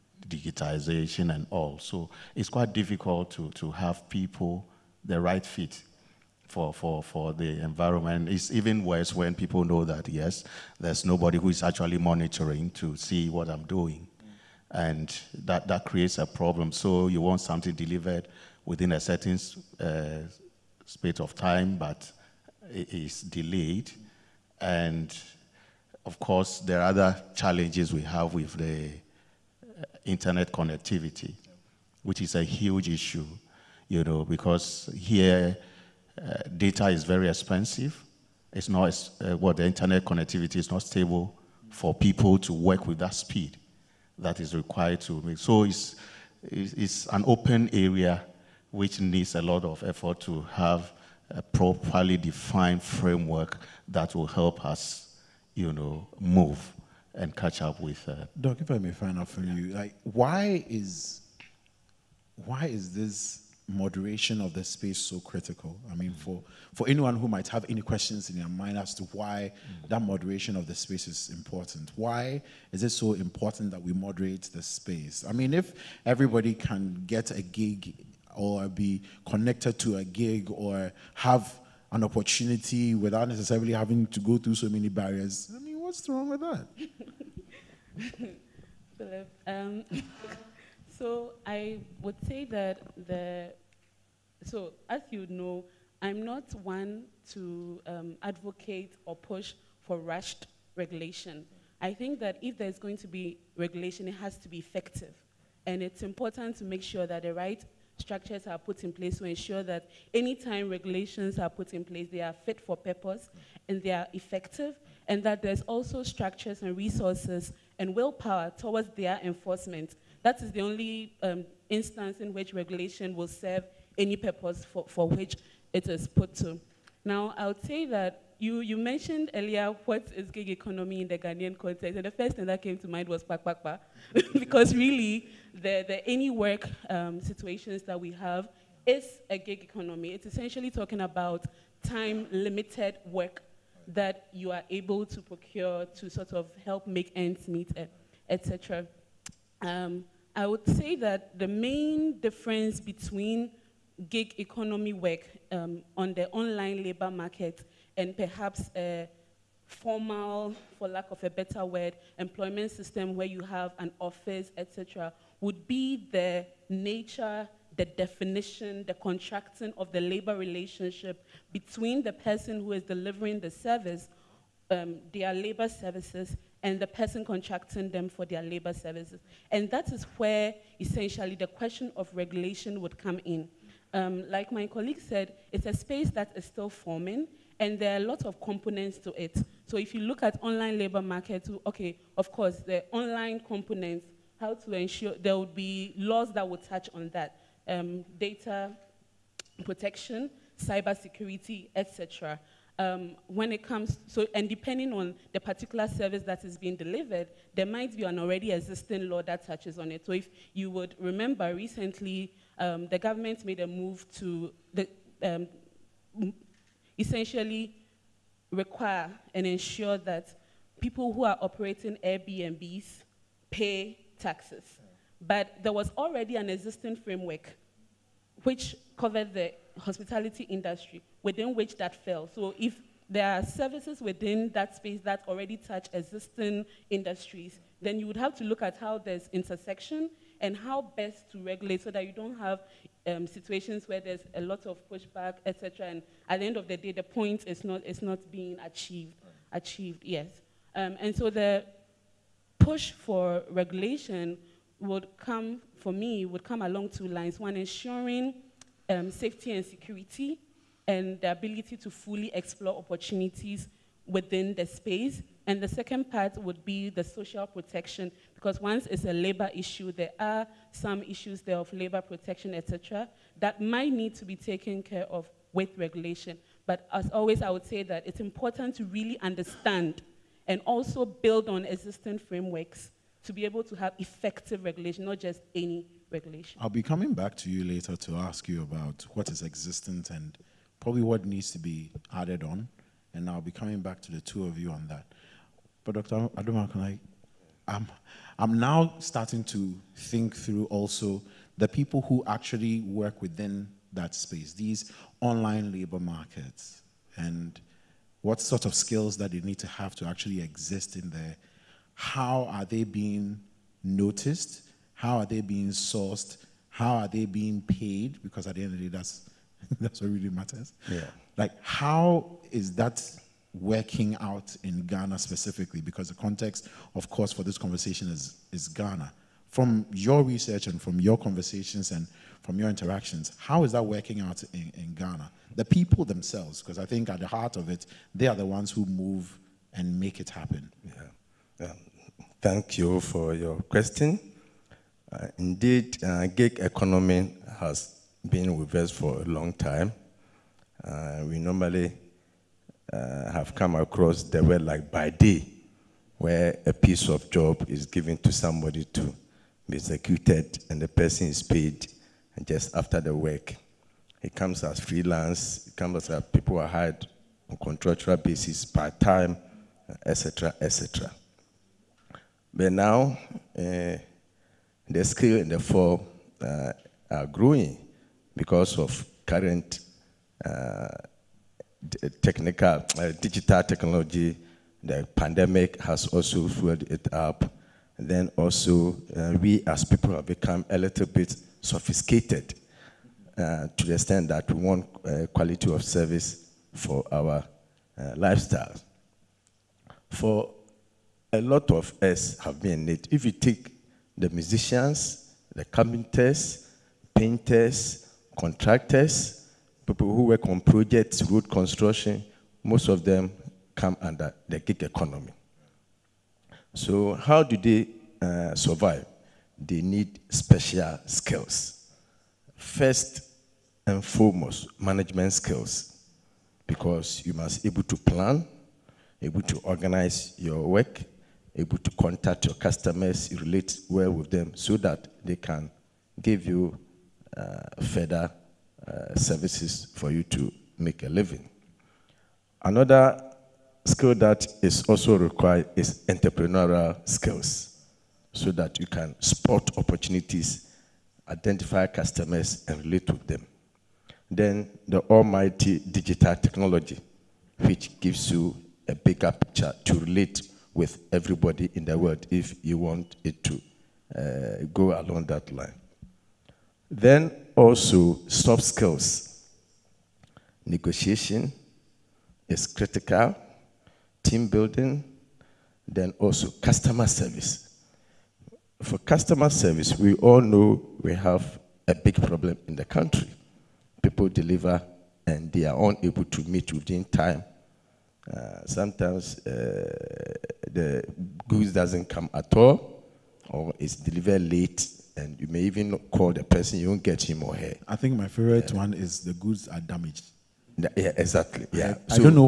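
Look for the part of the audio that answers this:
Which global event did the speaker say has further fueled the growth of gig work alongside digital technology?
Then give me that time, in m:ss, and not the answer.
6:25.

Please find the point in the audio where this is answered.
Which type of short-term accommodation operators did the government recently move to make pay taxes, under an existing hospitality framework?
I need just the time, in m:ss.
3:42.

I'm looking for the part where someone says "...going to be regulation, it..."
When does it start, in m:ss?
1:42.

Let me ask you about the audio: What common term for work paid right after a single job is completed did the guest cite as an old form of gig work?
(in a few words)
By day.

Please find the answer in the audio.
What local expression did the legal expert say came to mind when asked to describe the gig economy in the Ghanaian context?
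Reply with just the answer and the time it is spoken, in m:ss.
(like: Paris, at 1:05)
pakpakpa, at 2:13.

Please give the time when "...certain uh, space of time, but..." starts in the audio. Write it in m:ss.
0:19.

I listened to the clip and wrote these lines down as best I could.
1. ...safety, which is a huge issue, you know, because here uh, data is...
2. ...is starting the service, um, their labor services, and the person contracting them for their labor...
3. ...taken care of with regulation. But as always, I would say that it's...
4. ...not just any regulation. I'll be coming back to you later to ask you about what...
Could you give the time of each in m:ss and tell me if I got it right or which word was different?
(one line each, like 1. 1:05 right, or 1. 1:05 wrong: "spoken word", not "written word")
1. 0:30 wrong: "connectivity", not "safety"
2. 2:52 wrong: "delivering", not "starting"
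3. 4:34 right
4. 4:45 right.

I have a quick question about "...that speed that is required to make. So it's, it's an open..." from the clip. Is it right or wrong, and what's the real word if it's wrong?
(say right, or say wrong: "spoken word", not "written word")
right.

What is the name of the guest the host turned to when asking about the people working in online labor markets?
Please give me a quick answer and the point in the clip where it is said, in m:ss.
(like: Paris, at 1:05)
Dr. Adoma, at 4:55.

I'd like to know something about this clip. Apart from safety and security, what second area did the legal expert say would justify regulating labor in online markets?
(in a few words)
Social protection.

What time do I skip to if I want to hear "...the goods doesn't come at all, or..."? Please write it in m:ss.
8:10.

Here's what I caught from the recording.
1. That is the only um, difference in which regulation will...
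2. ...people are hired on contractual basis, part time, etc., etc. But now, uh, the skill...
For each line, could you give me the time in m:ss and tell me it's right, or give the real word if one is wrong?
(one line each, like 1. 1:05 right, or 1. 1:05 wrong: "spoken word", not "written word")
1. 2:00 wrong: "instance", not "difference"
2. 6:06 right.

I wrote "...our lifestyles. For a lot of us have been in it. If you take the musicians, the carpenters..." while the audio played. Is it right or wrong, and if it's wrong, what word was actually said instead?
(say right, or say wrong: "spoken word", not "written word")
right.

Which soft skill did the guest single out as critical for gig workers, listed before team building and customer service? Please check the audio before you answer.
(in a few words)
Negotiation.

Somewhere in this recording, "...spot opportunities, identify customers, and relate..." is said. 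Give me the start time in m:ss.
7:29.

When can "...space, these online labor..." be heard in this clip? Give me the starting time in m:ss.
5:04.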